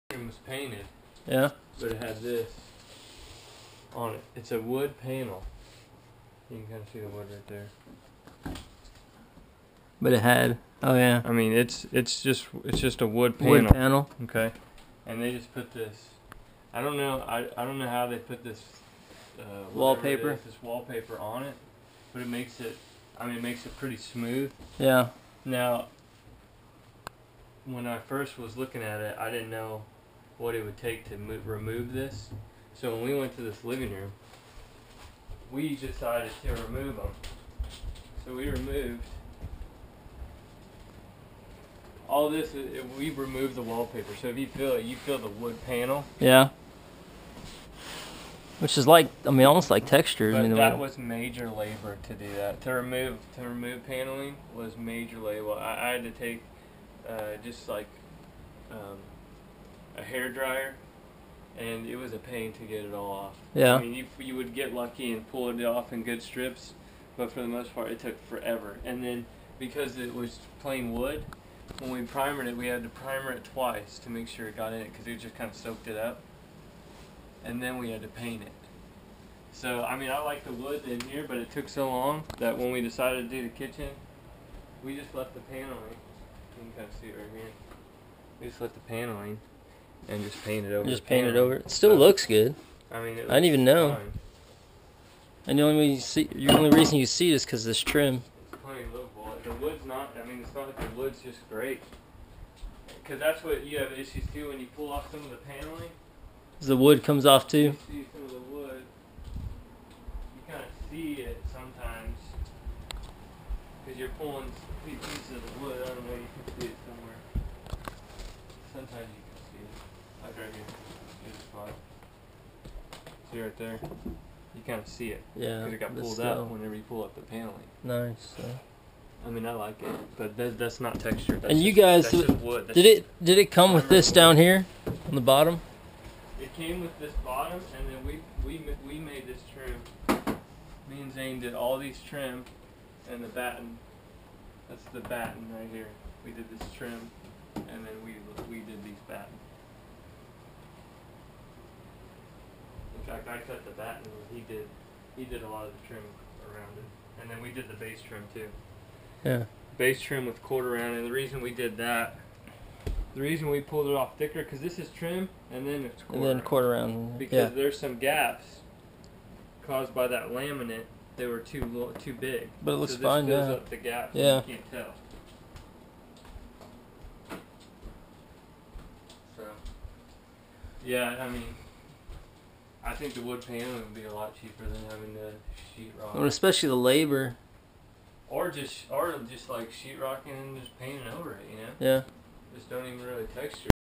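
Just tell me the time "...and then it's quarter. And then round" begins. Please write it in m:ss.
2:45.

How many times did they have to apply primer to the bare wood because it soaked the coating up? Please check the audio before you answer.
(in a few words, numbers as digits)
twice.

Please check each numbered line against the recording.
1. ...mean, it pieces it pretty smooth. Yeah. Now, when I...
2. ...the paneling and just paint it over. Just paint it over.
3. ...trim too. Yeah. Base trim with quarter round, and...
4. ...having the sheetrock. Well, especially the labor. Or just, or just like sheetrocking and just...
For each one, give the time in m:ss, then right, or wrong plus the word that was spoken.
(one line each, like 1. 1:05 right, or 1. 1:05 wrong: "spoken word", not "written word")
1. 0:23 wrong: "makes", not "pieces"
2. 1:28 right
3. 2:38 right
4. 3:04 right.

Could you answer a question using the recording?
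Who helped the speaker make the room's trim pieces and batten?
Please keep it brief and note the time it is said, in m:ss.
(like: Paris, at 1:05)
Zane, at 2:21.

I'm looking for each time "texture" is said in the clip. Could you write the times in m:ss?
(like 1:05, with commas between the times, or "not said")
0:49, 2:10, 3:13.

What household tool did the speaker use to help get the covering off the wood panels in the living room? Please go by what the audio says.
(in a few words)
hair dryer.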